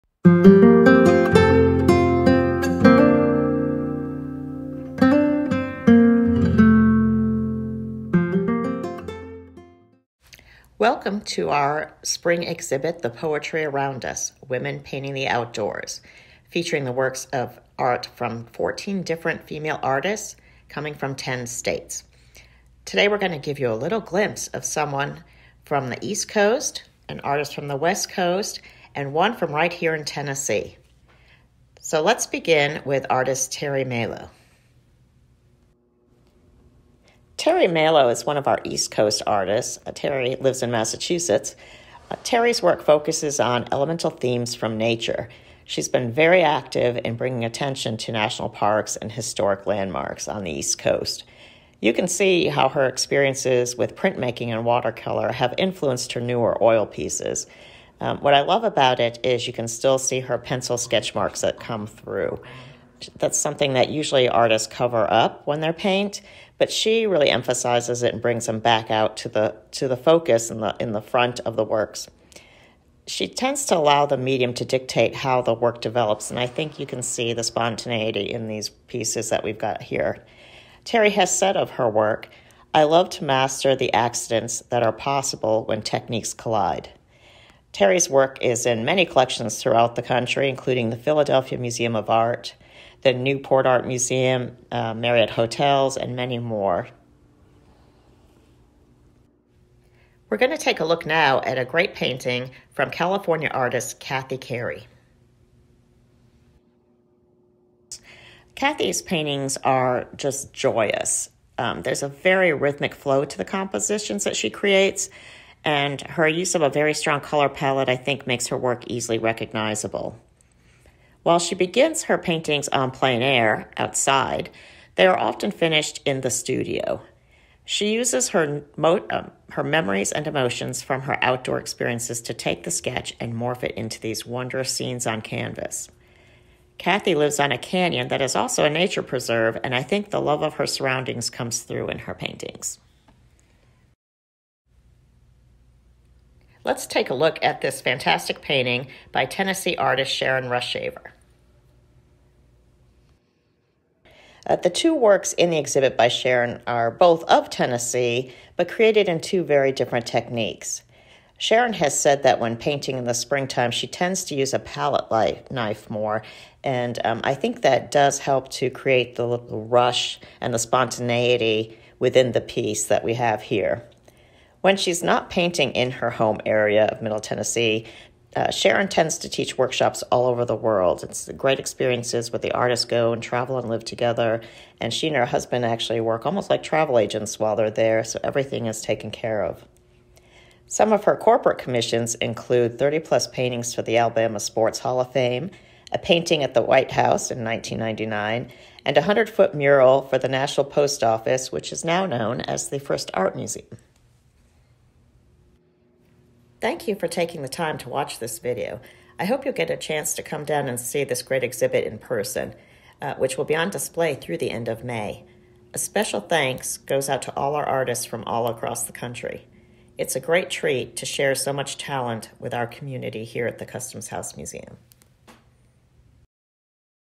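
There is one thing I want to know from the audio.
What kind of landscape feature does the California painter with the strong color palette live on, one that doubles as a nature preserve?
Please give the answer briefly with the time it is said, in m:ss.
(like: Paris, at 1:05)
A canyon, at 2:17.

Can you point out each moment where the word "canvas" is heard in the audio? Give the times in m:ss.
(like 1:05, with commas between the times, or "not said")
2:15.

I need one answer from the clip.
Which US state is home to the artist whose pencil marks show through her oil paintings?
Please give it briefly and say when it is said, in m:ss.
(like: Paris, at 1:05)
Massachusetts, at 0:40.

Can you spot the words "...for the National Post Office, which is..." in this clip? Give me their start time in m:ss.
3:20.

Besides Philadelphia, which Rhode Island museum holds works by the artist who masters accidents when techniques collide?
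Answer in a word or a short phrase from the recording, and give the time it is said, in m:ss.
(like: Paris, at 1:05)
Newport Art Museum, at 1:33.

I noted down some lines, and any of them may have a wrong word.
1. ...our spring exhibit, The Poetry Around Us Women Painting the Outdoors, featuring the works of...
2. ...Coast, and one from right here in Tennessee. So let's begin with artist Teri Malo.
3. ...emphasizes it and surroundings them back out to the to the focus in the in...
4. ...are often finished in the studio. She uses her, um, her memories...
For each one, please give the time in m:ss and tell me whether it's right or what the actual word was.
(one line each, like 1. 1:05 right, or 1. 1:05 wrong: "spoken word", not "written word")
1. 0:11 right
2. 0:28 right
3. 1:07 wrong: "brings", not "surroundings"
4. 2:05 right.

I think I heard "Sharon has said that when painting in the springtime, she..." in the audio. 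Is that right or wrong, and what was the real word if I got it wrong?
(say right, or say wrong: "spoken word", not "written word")
right.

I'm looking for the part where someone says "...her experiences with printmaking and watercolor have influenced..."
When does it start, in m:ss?
0:52.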